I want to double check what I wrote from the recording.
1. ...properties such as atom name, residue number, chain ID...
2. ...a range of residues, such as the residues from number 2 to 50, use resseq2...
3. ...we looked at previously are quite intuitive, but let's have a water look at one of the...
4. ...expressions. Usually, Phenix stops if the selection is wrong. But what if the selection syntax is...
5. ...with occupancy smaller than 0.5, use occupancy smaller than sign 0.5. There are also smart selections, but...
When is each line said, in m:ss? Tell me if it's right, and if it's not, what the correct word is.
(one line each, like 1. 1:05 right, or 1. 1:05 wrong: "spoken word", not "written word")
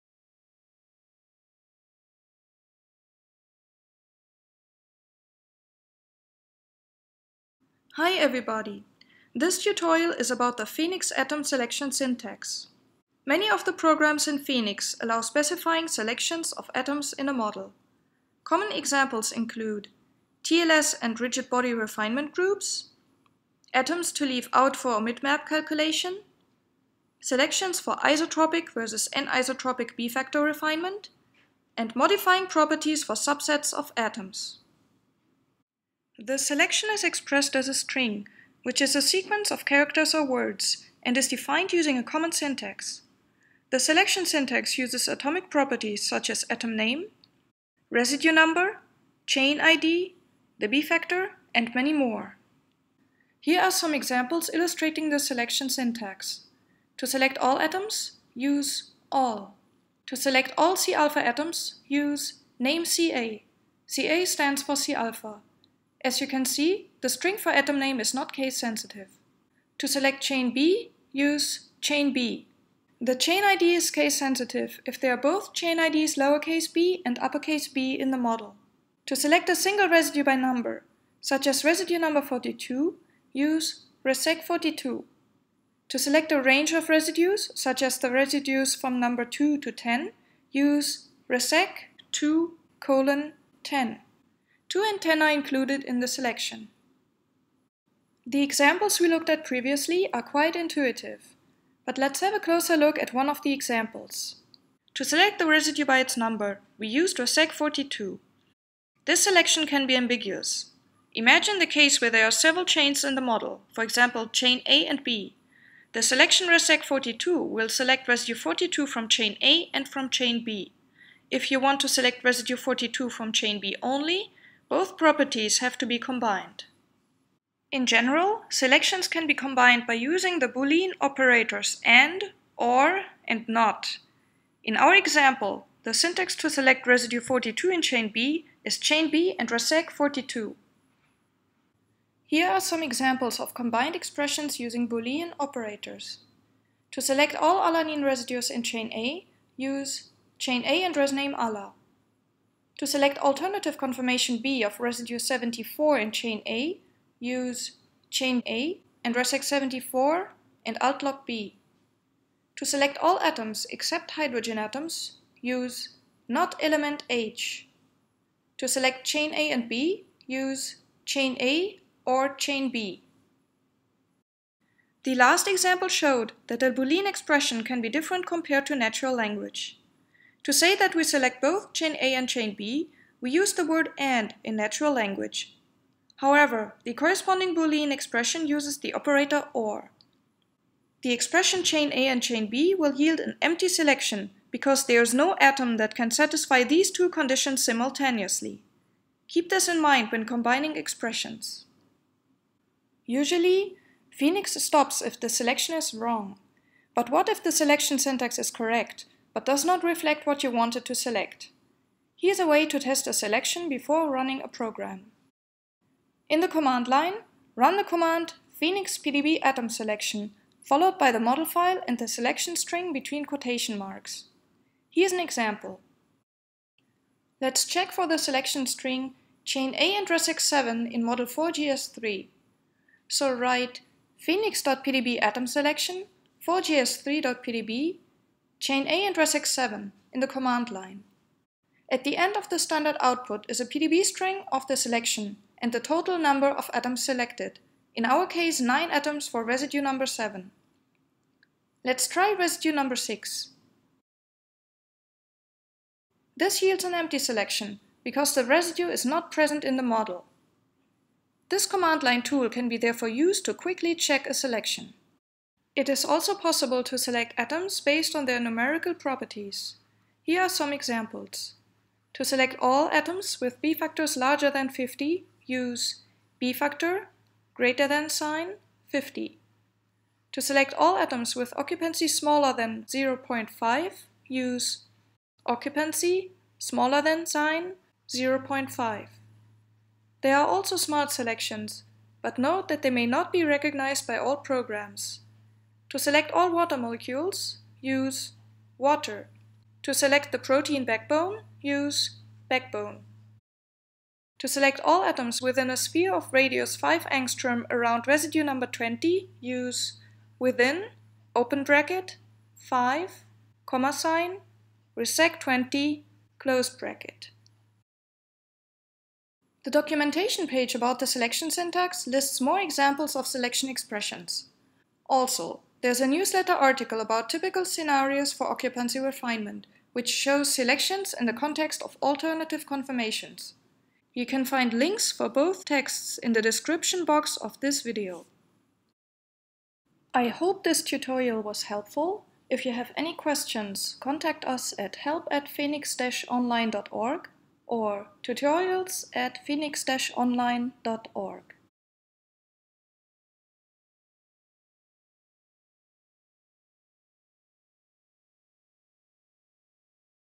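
1. 0:45 right
2. 1:26 wrong: "10", not "50"
3. 1:39 wrong: "closer", not "water"
4. 3:20 right
5. 4:41 right.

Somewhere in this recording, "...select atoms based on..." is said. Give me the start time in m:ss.
4:26.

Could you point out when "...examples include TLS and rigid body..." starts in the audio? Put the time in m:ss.
0:18.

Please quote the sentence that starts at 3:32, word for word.
Here's a way to test a selection before running a program.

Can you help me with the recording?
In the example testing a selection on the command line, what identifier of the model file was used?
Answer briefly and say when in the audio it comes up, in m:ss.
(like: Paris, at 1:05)
4GS3, at 3:51.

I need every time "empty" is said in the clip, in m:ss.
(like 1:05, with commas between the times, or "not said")
3:13, 4:16.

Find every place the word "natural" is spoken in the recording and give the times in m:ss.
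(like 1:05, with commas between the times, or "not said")
2:58, 3:04.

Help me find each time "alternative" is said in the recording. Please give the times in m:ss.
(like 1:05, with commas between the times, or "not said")
2:33, 5:32.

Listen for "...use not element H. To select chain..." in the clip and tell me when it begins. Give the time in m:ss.
2:45.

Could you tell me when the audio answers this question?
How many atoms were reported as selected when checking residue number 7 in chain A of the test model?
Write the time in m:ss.
4:08.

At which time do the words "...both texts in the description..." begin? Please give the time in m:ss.
5:35.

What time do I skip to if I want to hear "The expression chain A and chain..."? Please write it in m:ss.
3:11.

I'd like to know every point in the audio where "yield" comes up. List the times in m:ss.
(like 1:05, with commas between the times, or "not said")
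3:12, 4:16.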